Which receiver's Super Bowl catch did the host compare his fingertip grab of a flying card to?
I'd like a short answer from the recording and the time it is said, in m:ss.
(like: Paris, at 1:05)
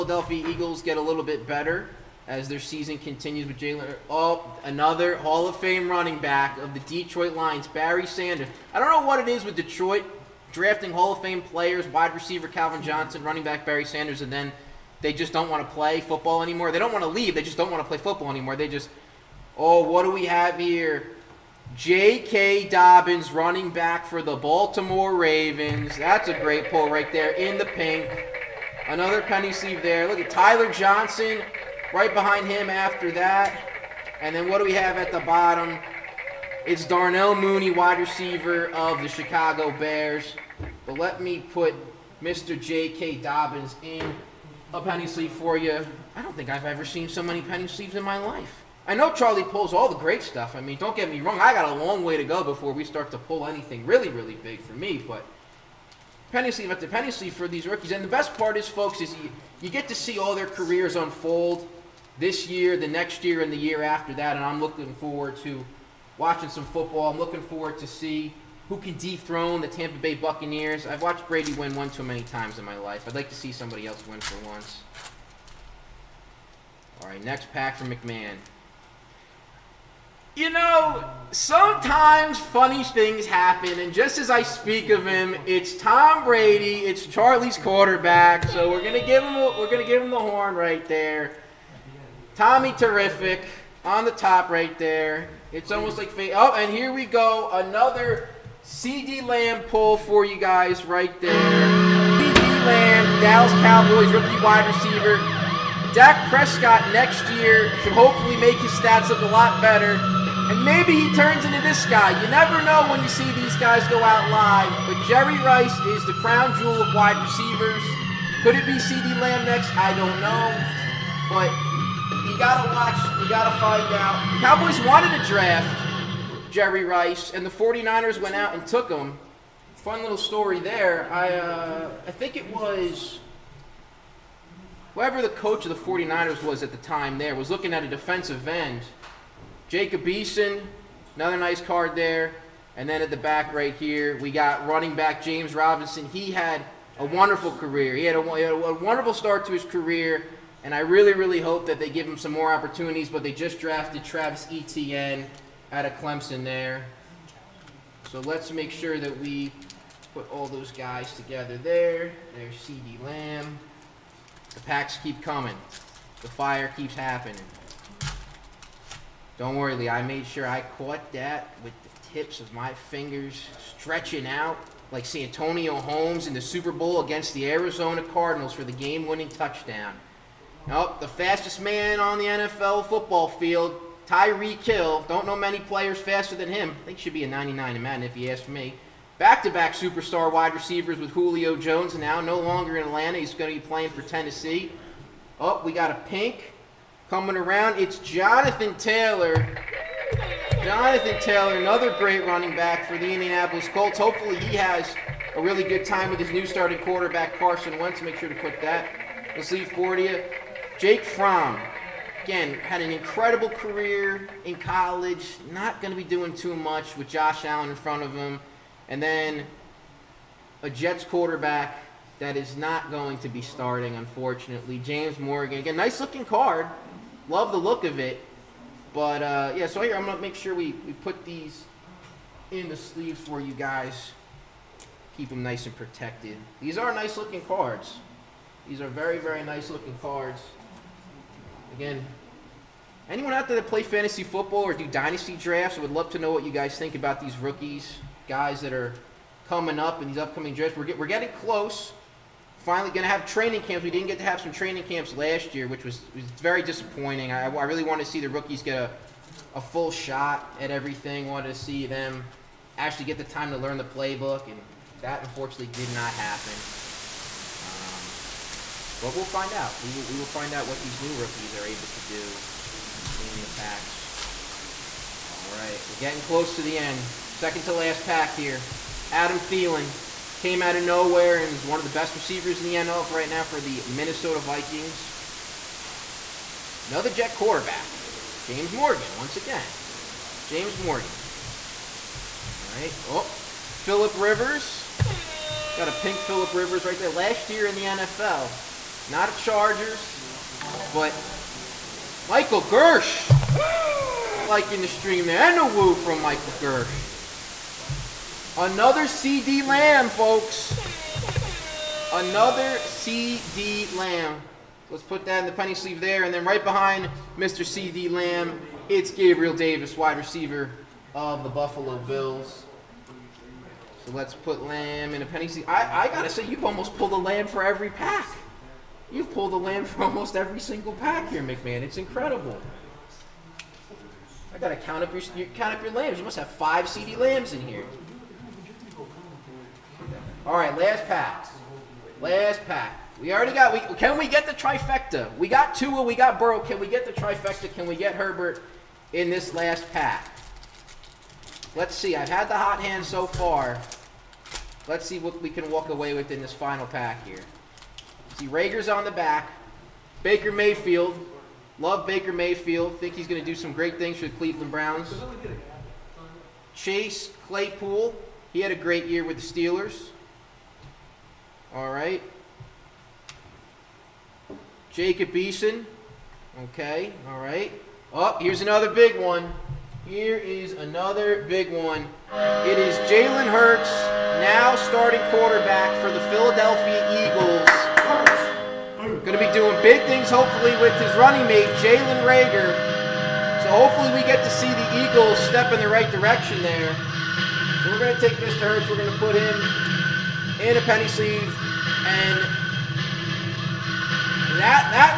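Santonio Holmes, at 2:55.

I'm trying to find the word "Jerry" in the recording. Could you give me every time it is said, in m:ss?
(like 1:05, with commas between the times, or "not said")
1:55, 2:06.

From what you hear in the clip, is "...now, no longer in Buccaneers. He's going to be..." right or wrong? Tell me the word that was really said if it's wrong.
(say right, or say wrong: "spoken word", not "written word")
wrong: "Atlanta", not "Buccaneers".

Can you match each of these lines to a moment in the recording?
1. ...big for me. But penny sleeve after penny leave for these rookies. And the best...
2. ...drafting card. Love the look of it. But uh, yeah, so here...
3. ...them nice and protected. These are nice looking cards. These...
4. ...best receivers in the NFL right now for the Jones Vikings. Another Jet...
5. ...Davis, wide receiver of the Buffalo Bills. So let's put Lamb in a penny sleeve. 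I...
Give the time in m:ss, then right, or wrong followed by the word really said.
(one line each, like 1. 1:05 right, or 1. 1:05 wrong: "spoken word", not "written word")
1. 0:54 wrong: "sleeve", not "leave"
2. 3:46 wrong: "looking", not "drafting"
3. 3:55 right
4. 4:41 wrong: "Minnesota", not "Jones"
5. 5:19 right.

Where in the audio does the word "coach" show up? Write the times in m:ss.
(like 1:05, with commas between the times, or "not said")
2:15.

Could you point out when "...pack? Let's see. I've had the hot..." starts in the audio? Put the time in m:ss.
5:49.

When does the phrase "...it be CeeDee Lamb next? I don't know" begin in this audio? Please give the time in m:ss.
1:58.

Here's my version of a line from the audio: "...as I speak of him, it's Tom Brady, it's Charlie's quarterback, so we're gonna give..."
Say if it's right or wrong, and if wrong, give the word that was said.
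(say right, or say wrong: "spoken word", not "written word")
right.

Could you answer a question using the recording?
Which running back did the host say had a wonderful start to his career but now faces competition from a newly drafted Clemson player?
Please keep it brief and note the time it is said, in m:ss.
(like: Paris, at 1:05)
James Robinson, at 2:25.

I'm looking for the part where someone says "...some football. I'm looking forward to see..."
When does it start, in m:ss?
1:06.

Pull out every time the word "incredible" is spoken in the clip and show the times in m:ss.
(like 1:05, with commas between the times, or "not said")
3:32, 5:31.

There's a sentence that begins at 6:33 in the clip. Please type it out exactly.
So hopefully we get to see the Eagles step in the right direction there.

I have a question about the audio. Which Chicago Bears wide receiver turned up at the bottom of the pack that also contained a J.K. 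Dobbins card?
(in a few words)
Darnell Mooney.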